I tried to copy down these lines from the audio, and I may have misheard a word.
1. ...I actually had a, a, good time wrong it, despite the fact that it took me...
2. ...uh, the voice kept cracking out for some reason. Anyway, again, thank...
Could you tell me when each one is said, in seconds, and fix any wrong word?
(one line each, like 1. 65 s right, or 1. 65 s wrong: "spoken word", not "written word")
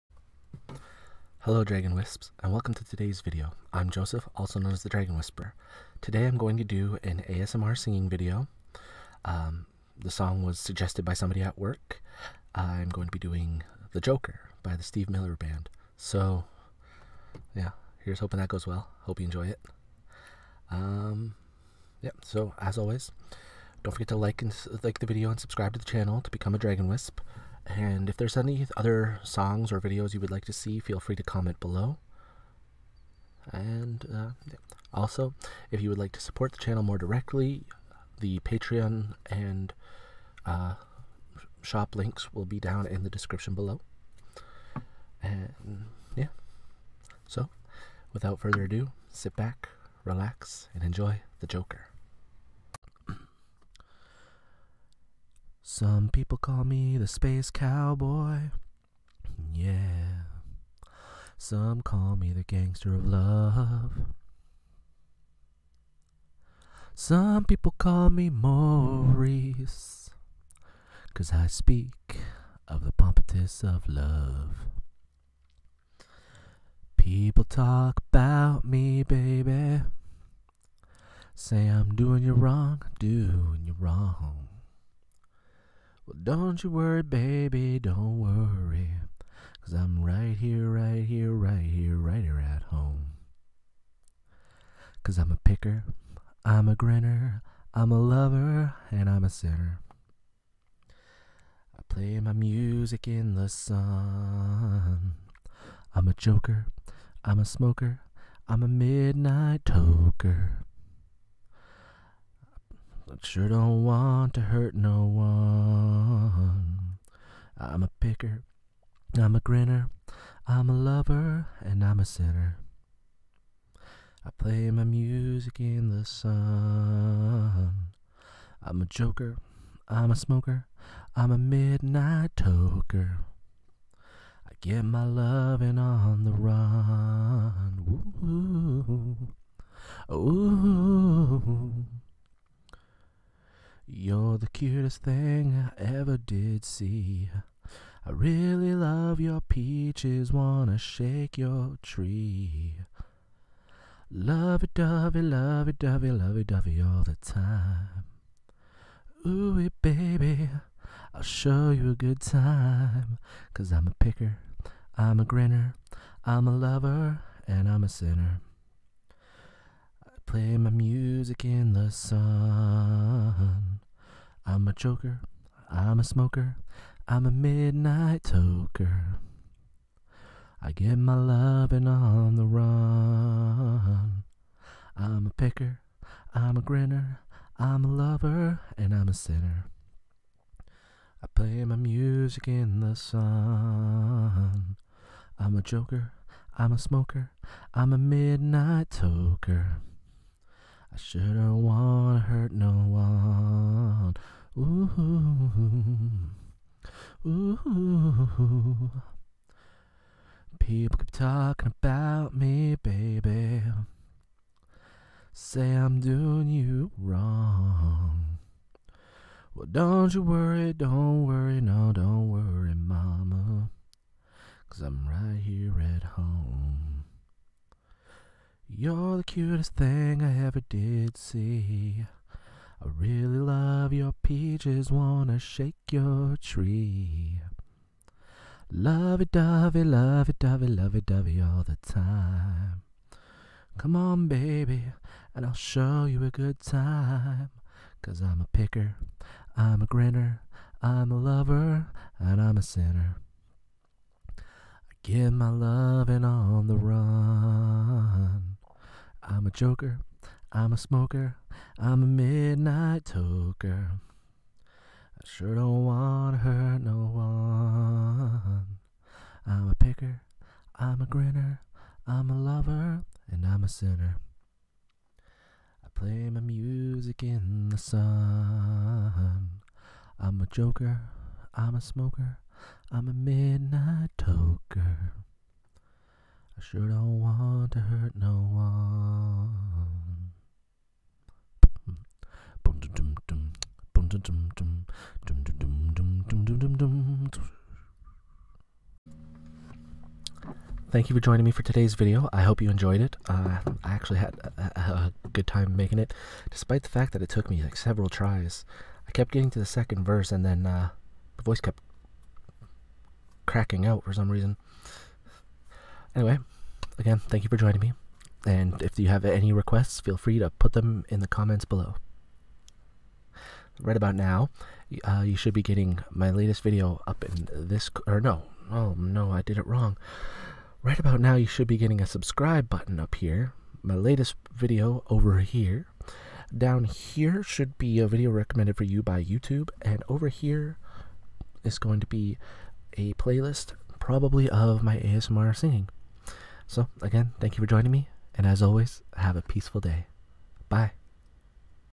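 1. 303 s wrong: "making", not "wrong"
2. 310 s right.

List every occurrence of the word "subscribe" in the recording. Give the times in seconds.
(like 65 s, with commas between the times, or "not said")
25 s, 332 s.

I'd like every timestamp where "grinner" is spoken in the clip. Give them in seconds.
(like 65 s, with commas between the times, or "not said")
96 s, 119 s, 165 s, 186 s, 249 s, 271 s.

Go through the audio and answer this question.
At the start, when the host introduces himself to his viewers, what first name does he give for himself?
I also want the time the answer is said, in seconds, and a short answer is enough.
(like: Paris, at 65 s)
Joseph, at 3 s.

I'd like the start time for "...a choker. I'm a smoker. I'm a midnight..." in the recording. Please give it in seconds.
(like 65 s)
174 s.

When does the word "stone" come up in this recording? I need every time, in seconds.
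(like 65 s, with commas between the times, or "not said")
not said.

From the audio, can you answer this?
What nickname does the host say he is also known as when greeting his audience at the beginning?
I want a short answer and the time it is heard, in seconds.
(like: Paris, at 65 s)
the Dragon Whisperer, at 4 s.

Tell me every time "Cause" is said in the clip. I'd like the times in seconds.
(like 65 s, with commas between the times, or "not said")
71 s, 89 s, 95 s, 163 s, 224 s, 248 s.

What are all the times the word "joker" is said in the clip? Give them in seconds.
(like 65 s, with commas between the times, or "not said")
14 s, 51 s, 106 s, 128 s, 195 s, 259 s, 280 s.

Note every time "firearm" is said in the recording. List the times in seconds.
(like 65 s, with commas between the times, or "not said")
not said.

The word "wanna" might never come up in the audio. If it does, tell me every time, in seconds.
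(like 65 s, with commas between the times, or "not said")
150 s, 201 s, 234 s.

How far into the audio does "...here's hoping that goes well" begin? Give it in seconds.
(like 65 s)
18 s.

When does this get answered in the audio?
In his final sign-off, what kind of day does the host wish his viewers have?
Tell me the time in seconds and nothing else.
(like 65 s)
349 s.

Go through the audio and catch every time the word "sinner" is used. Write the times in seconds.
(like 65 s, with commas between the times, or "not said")
99 s, 122 s, 167 s, 189 s, 252 s, 273 s.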